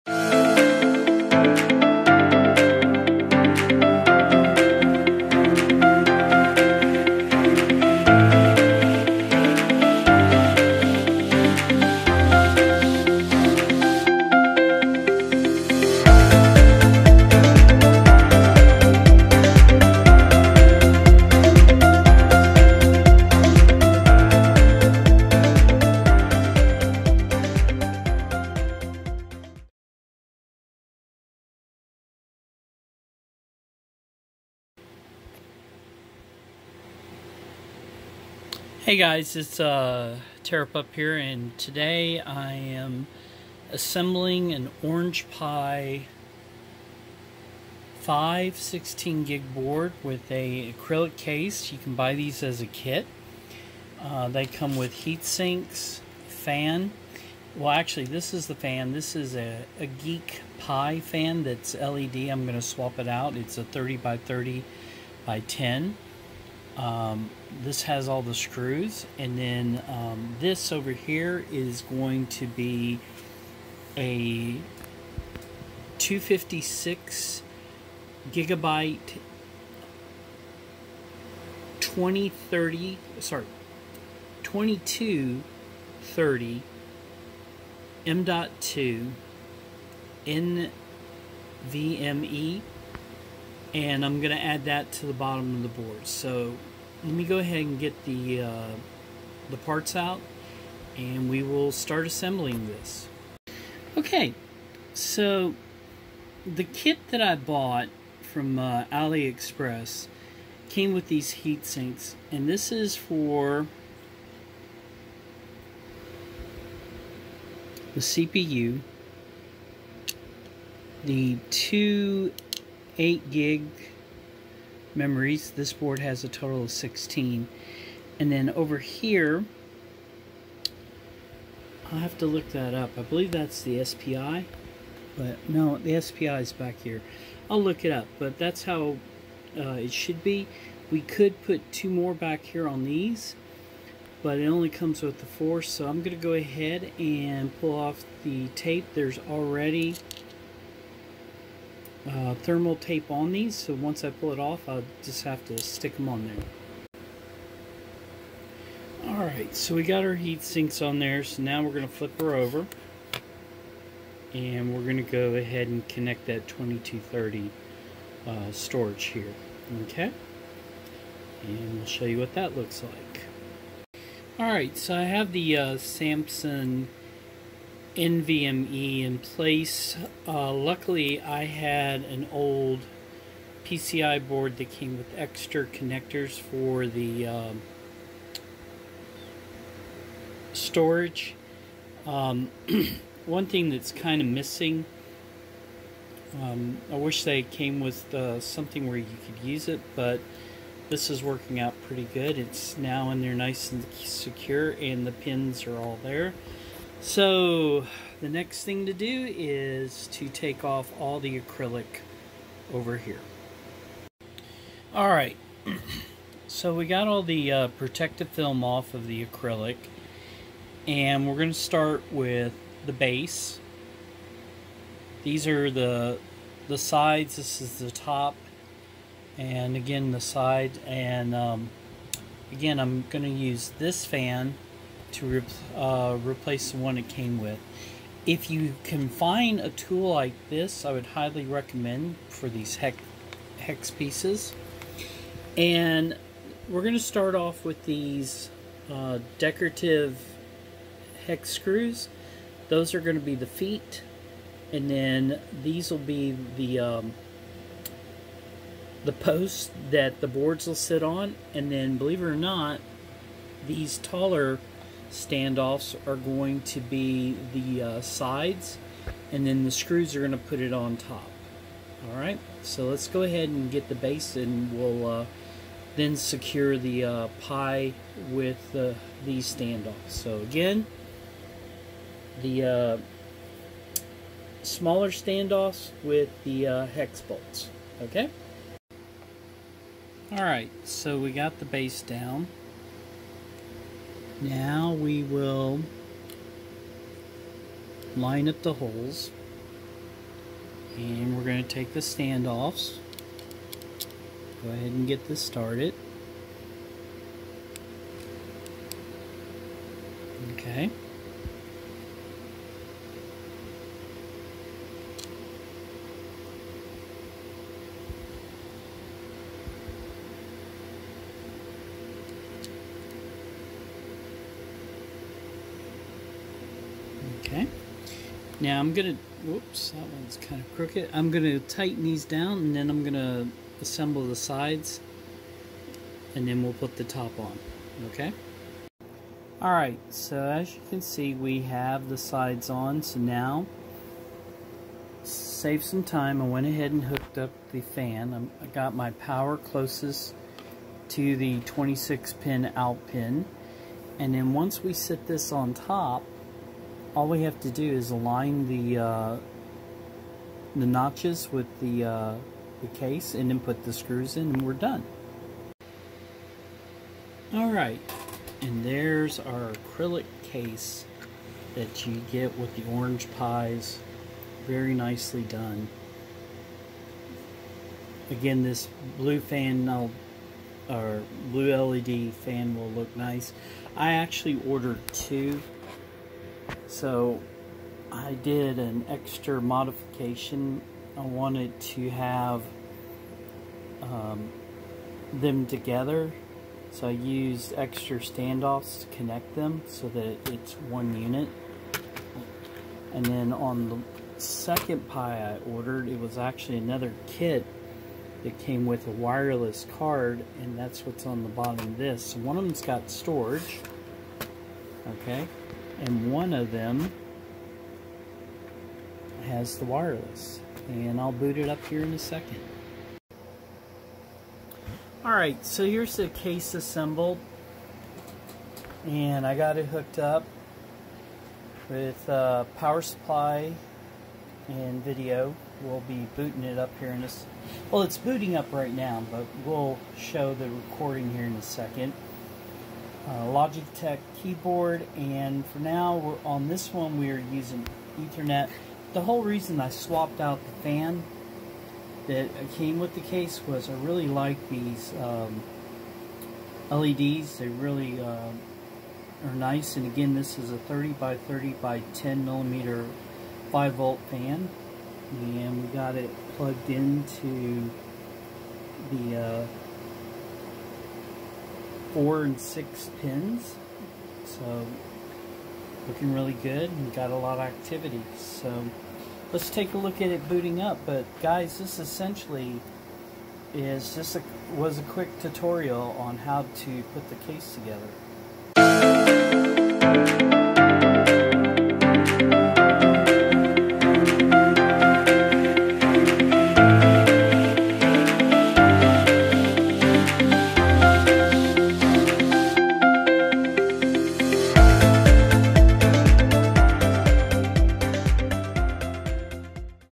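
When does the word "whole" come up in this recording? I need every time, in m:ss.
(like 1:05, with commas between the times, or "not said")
7:29.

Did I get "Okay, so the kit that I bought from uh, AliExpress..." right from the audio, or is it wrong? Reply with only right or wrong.
right.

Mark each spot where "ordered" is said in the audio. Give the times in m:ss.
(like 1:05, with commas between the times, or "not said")
6:24, 6:45.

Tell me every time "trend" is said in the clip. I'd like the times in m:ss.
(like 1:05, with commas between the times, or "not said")
not said.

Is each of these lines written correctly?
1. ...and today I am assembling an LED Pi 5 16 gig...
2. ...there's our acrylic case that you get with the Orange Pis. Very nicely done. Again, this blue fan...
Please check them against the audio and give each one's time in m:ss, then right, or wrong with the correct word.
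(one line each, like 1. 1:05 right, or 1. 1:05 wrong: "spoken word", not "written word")
1. 0:41 wrong: "Orange", not "LED"
2. 6:08 right.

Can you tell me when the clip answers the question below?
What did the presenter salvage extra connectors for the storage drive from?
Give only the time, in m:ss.
3:02.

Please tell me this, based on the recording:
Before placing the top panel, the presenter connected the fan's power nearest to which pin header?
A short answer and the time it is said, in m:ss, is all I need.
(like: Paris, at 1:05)
26 pin, at 5:51.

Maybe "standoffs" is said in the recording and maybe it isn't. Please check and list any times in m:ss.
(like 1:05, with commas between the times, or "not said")
4:25, 4:39, 4:45, 5:01, 6:38.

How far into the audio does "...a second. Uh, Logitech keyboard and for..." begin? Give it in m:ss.
7:21.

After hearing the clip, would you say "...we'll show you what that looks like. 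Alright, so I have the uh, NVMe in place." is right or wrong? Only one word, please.
right.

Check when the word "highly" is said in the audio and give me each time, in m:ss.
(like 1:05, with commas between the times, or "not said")
4:01.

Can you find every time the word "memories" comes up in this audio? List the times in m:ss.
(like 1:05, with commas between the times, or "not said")
2:04.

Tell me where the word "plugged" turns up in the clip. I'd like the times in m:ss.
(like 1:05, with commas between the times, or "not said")
7:46.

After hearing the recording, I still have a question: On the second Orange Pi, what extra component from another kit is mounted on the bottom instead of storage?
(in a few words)
Wireless card.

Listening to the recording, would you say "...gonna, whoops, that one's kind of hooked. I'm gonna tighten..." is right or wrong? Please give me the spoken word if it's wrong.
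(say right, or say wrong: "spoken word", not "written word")
wrong: "crooked", not "hooked".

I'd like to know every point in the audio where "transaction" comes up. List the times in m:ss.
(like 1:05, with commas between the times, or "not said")
not said.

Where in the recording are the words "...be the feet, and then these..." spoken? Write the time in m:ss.
4:13.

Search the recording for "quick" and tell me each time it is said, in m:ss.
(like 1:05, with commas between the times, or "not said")
8:05.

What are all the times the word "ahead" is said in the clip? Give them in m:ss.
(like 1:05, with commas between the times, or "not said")
1:37, 2:26, 2:45, 4:33, 5:04, 5:46.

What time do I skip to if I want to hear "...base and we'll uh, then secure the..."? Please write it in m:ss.
4:33.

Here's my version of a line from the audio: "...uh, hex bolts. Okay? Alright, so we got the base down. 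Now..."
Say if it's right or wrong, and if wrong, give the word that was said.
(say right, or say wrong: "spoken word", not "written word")
right.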